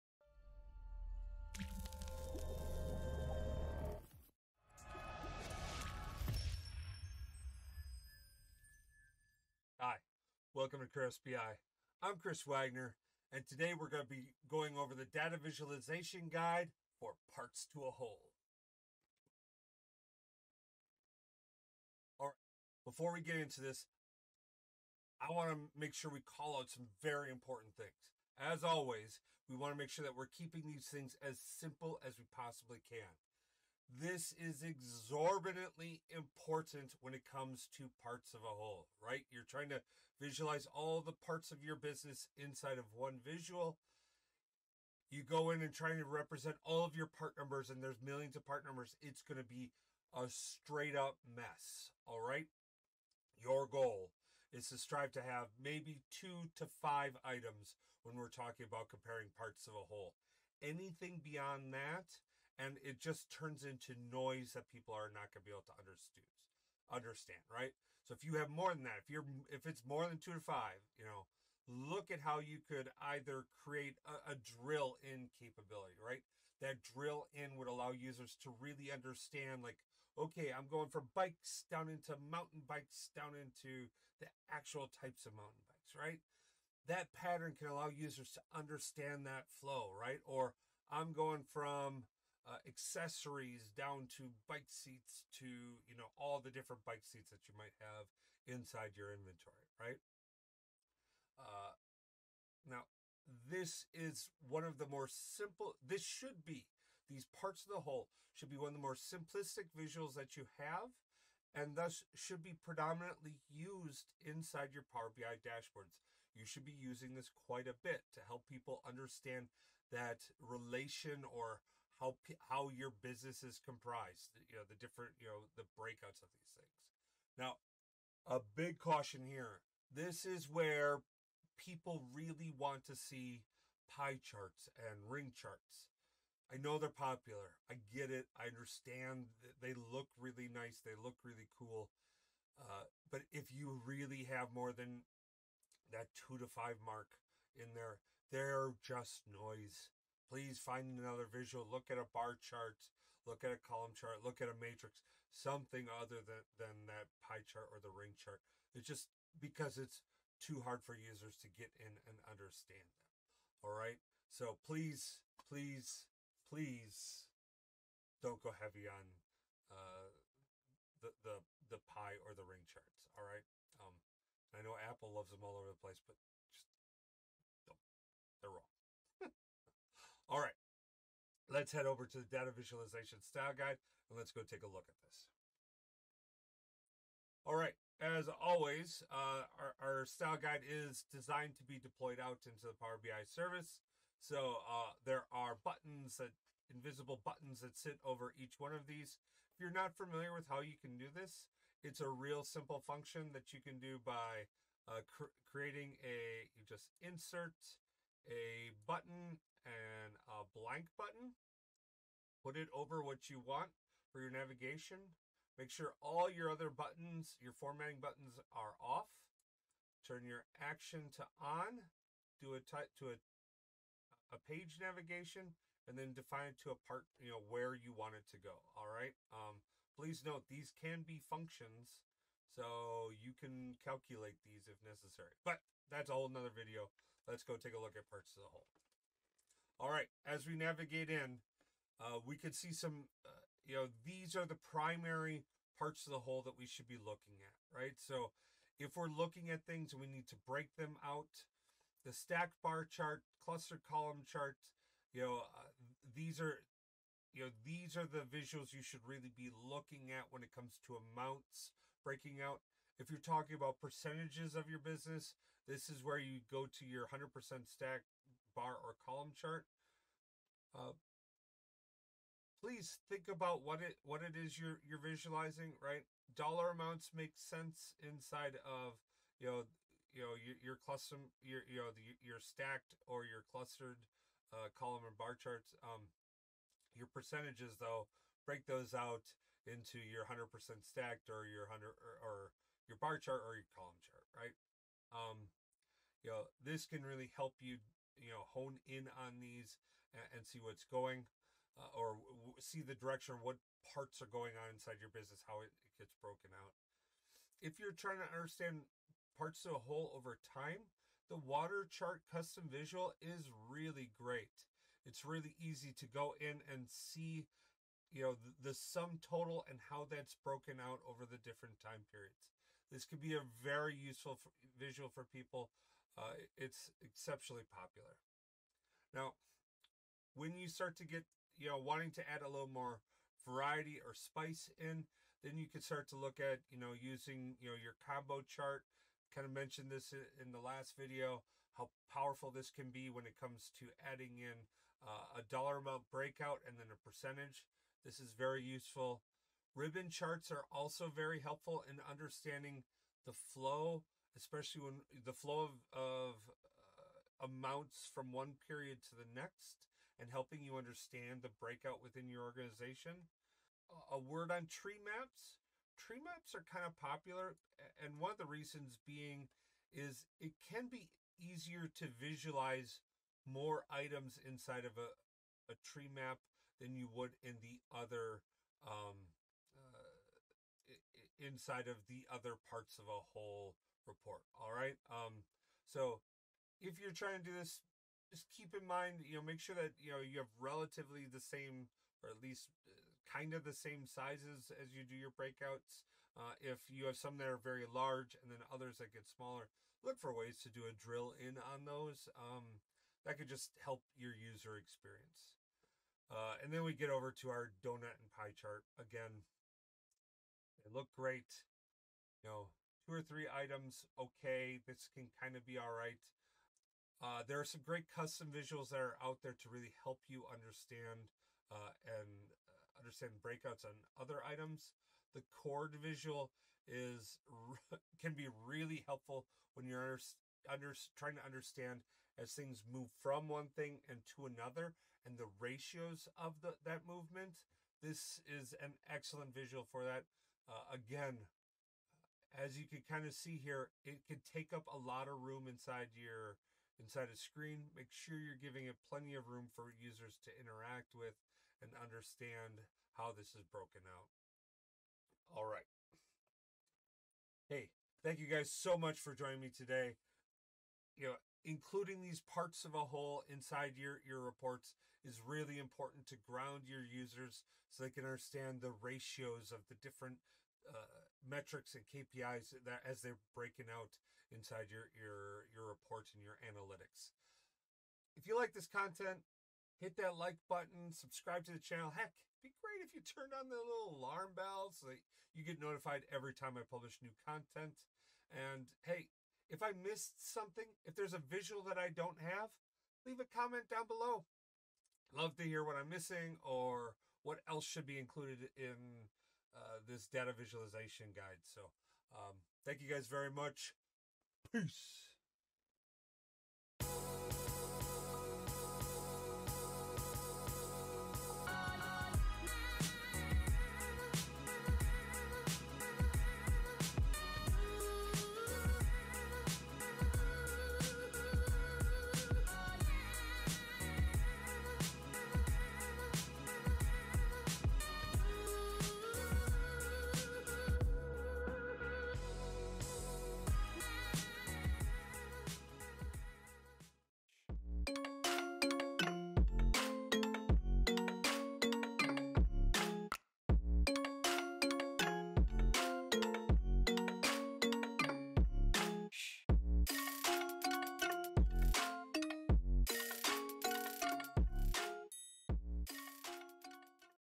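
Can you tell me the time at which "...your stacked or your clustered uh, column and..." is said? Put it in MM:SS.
04:42.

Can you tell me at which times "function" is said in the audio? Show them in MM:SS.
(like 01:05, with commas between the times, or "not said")
03:22, 03:51.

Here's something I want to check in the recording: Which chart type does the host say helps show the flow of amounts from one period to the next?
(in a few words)
Ribbon charts.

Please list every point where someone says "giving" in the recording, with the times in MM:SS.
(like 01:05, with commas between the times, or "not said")
07:28.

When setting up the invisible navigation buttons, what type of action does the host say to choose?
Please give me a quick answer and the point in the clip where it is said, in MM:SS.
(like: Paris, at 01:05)
page navigation, at 03:44.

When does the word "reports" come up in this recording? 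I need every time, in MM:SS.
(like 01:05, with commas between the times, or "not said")
06:24, 07:44, 07:55.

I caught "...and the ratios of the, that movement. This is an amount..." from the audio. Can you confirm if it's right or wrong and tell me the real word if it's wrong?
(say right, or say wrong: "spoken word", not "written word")
wrong: "excellent", not "amount".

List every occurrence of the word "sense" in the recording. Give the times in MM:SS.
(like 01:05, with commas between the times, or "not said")
04:37.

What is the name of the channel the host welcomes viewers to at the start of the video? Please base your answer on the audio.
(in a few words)
KratosBI.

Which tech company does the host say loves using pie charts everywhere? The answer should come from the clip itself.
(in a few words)
Apple.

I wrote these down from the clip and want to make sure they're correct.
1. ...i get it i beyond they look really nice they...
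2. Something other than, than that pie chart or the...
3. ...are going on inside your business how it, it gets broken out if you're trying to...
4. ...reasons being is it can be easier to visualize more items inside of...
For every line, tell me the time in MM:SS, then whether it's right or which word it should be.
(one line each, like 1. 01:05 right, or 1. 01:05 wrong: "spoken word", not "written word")
1. 02:17 wrong: "understand", not "beyond"
2. 02:35 right
3. 05:04 right
4. 06:08 right.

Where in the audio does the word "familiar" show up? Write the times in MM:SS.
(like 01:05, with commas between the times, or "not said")
03:19.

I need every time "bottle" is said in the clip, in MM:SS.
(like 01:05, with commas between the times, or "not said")
not said.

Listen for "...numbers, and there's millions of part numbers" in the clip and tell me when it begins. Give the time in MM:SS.
00:47.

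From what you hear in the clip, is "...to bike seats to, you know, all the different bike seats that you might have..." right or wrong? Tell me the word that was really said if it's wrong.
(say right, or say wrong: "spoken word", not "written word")
right.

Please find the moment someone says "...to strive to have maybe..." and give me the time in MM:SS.
00:54.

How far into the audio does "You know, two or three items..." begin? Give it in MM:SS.
06:52.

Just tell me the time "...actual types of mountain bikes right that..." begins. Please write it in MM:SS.
01:24.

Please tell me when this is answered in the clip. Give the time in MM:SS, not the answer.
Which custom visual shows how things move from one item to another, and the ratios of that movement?
07:05.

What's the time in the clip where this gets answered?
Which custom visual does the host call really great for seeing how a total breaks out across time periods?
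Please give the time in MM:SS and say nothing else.
05:11.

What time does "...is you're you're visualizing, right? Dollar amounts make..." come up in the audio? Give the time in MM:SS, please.
04:34.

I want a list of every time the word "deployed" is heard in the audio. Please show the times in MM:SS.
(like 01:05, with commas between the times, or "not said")
03:11.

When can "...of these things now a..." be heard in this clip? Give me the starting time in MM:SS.
02:06.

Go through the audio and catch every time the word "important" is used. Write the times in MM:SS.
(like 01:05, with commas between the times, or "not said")
00:27, 00:36, 07:45.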